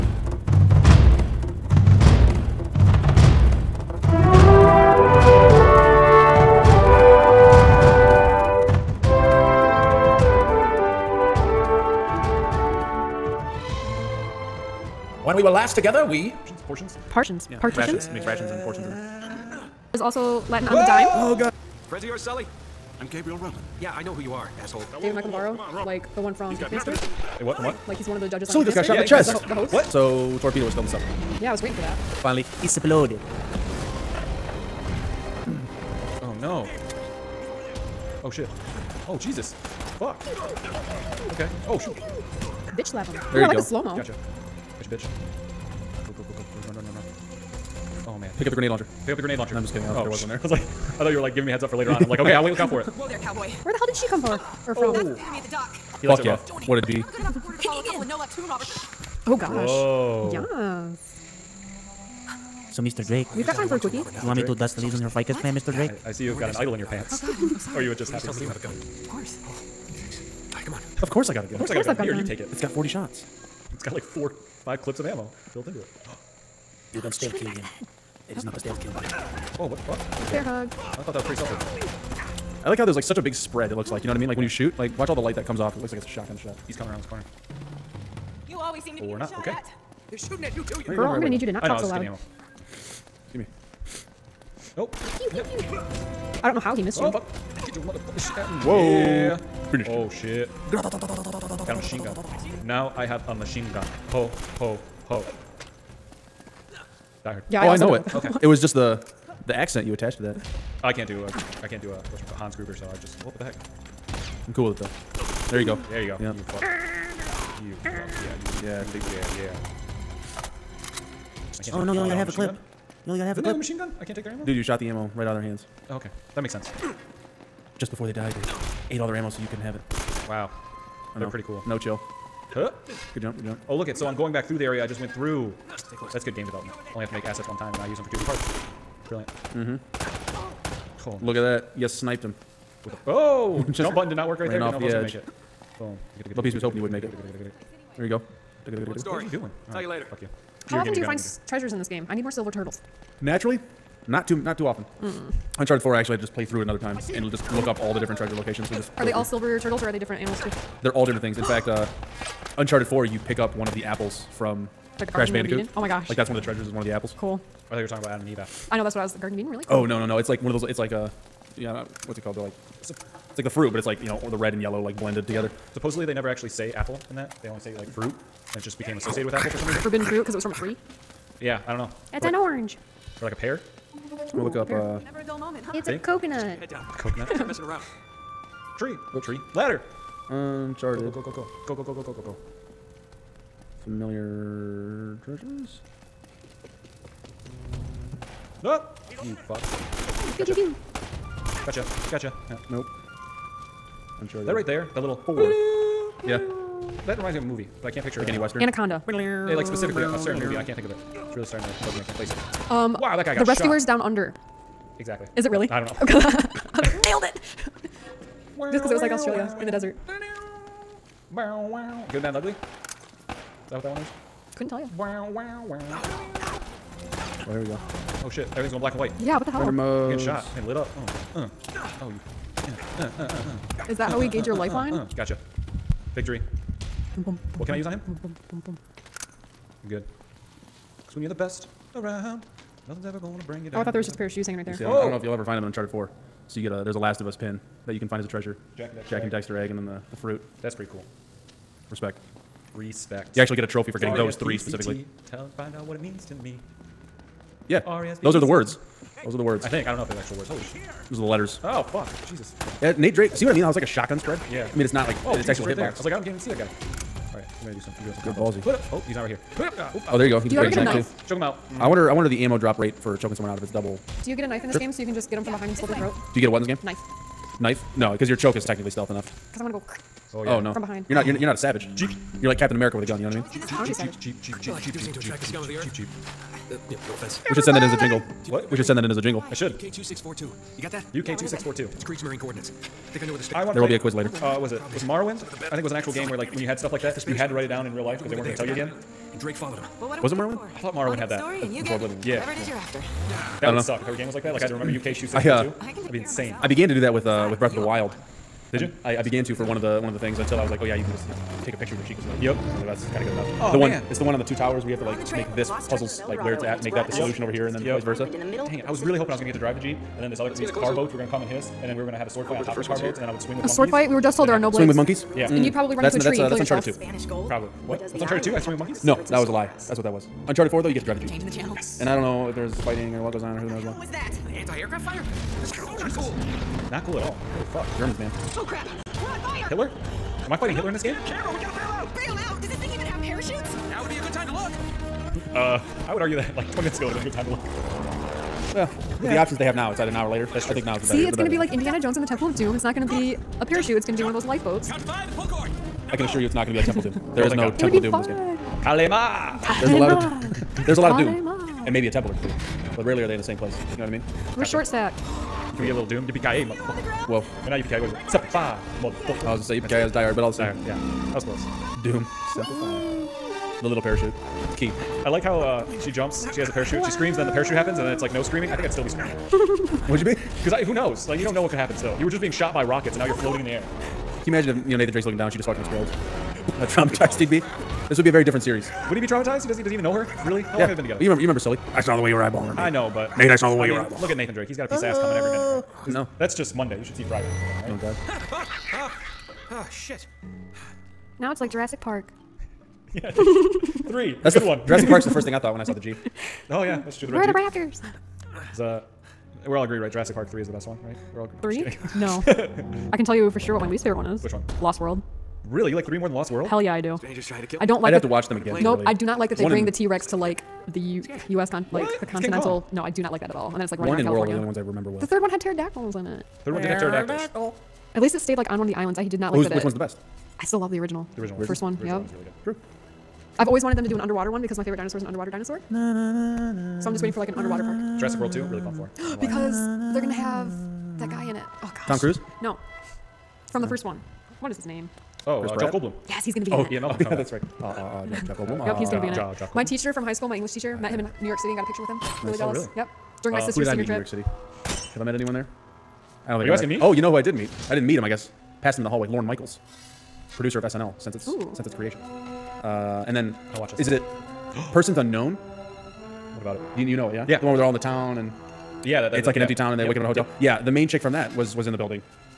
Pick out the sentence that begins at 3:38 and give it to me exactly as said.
Just because it was like Australia in the desert.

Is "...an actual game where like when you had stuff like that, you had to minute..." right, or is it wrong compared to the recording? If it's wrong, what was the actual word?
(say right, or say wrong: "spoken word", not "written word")
wrong: "write", not "minute".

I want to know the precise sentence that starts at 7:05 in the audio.
The third one had pterodactyls in it.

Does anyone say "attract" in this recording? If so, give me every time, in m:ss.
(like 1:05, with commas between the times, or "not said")
4:45.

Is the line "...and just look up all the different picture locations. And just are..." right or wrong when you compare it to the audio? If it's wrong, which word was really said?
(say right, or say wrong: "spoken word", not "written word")
wrong: "treasure", not "picture".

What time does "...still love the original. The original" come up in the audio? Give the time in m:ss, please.
7:10.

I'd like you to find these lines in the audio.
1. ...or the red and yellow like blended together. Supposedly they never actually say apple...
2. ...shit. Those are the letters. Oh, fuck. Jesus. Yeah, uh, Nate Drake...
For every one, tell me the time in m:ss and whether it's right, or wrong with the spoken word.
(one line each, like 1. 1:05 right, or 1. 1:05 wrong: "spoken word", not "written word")
1. 2:54 right
2. 4:20 right.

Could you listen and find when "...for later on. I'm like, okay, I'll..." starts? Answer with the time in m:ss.
0:51.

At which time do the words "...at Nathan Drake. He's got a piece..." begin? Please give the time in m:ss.
6:34.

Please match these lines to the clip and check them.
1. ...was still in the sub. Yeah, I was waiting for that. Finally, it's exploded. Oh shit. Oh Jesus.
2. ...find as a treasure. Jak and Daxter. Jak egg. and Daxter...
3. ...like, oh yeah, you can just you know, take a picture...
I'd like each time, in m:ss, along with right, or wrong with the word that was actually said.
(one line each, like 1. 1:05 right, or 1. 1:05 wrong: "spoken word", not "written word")
1. 0:30 right
2. 4:08 right
3. 5:10 right.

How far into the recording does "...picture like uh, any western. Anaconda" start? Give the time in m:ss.
3:28.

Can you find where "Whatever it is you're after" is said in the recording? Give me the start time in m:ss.
5:02.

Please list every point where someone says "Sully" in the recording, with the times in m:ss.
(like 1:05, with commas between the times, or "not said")
0:22, 0:28, 6:31.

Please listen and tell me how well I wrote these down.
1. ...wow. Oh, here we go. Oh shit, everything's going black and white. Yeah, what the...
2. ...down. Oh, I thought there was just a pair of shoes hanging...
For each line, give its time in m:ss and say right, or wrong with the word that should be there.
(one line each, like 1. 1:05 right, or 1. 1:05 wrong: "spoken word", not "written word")
1. 3:45 right
2. 4:03 right.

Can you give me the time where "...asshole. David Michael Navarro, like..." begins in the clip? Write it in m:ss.
0:24.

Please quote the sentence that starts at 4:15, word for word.
Tell, find out what it means to me.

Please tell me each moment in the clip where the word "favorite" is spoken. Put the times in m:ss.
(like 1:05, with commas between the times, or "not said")
6:54, 7:14.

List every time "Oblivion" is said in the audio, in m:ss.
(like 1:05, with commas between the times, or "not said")
5:01.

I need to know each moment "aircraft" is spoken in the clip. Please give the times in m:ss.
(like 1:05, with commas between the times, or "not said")
5:34.